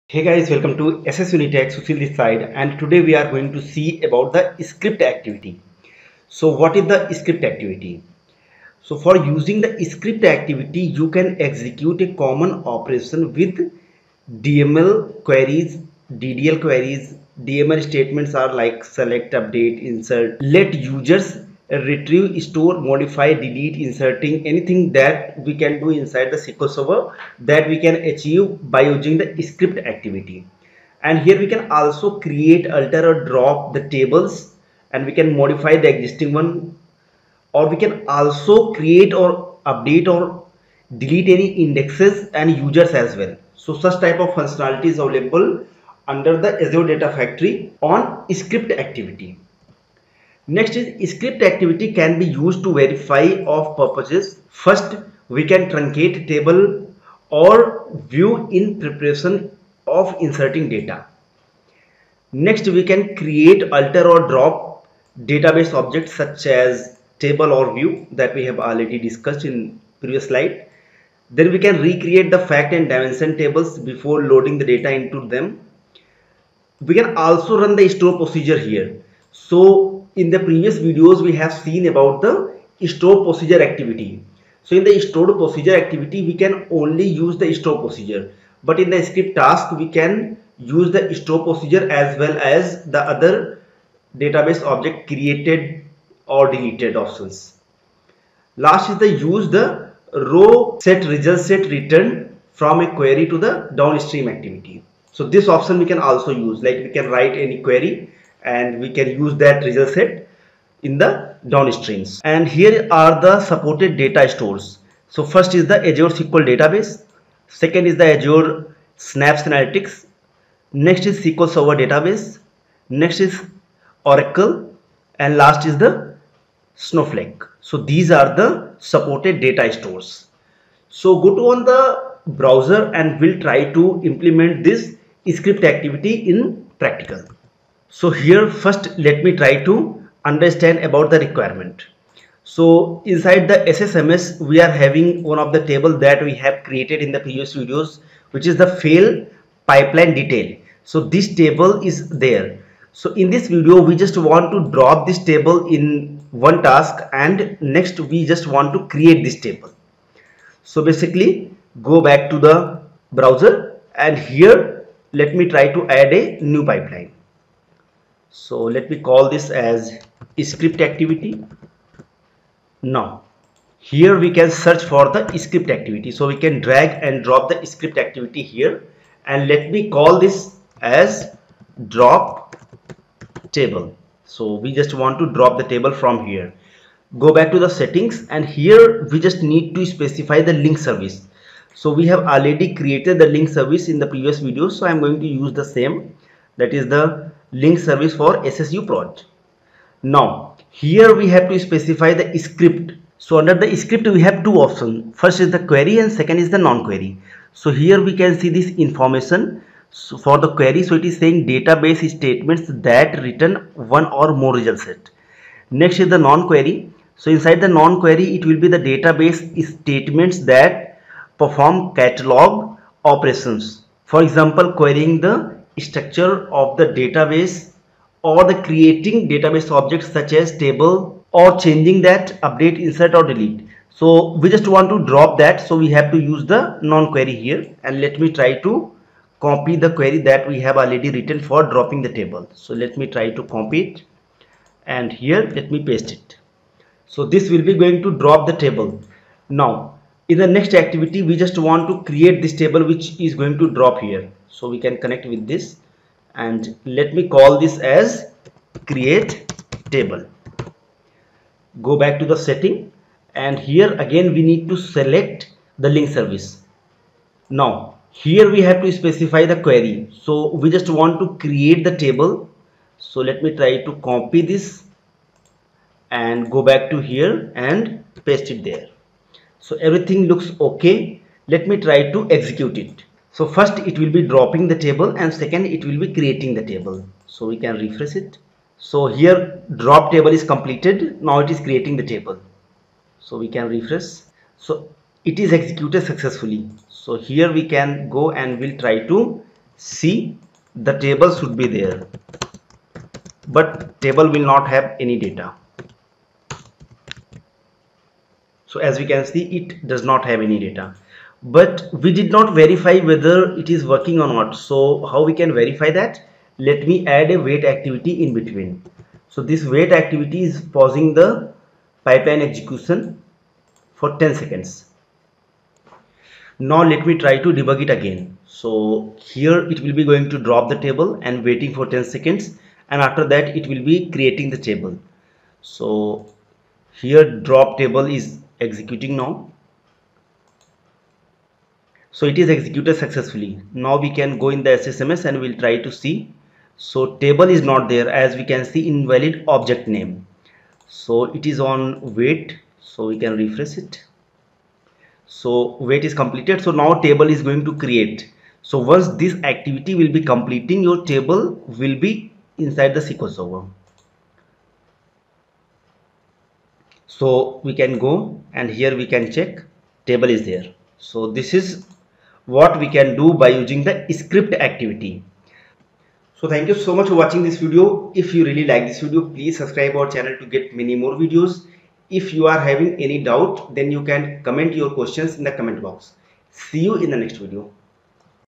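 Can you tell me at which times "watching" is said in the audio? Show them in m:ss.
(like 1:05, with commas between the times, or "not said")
6:17.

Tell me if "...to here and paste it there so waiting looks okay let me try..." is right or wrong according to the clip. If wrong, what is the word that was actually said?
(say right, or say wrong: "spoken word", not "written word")
wrong: "everything", not "waiting".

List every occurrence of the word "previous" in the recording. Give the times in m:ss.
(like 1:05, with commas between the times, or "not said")
1:09, 1:20, 2:27, 3:14.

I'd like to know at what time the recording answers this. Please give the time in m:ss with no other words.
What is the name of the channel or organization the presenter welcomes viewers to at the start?
0:01.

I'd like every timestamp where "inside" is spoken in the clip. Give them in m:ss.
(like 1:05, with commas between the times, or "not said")
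0:25, 2:23, 3:37, 6:02.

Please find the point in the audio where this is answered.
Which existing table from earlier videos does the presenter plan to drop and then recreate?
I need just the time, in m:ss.
2:28.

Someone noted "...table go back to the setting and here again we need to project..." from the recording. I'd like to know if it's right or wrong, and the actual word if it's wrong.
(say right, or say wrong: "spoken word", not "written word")
wrong: "select", not "project".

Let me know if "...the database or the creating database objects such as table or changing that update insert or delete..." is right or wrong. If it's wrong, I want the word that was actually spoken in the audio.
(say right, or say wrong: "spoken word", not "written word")
right.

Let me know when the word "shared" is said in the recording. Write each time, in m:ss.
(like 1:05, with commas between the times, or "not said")
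not said.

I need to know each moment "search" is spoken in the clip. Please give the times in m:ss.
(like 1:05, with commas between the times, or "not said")
2:54.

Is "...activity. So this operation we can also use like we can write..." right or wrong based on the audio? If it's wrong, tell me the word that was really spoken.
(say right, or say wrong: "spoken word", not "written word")
wrong: "option", not "operation".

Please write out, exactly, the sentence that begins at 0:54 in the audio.
First, we can truncate table or view in preparation of inserting data.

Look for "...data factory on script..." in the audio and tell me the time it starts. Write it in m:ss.
0:46.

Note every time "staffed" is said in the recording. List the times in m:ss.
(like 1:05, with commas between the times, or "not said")
not said.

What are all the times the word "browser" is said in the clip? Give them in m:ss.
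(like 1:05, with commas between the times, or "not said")
2:12, 2:43.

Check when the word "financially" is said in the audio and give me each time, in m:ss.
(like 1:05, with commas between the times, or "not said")
not said.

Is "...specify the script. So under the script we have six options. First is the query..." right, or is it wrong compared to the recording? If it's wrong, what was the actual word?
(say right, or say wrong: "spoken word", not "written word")
wrong: "two", not "six".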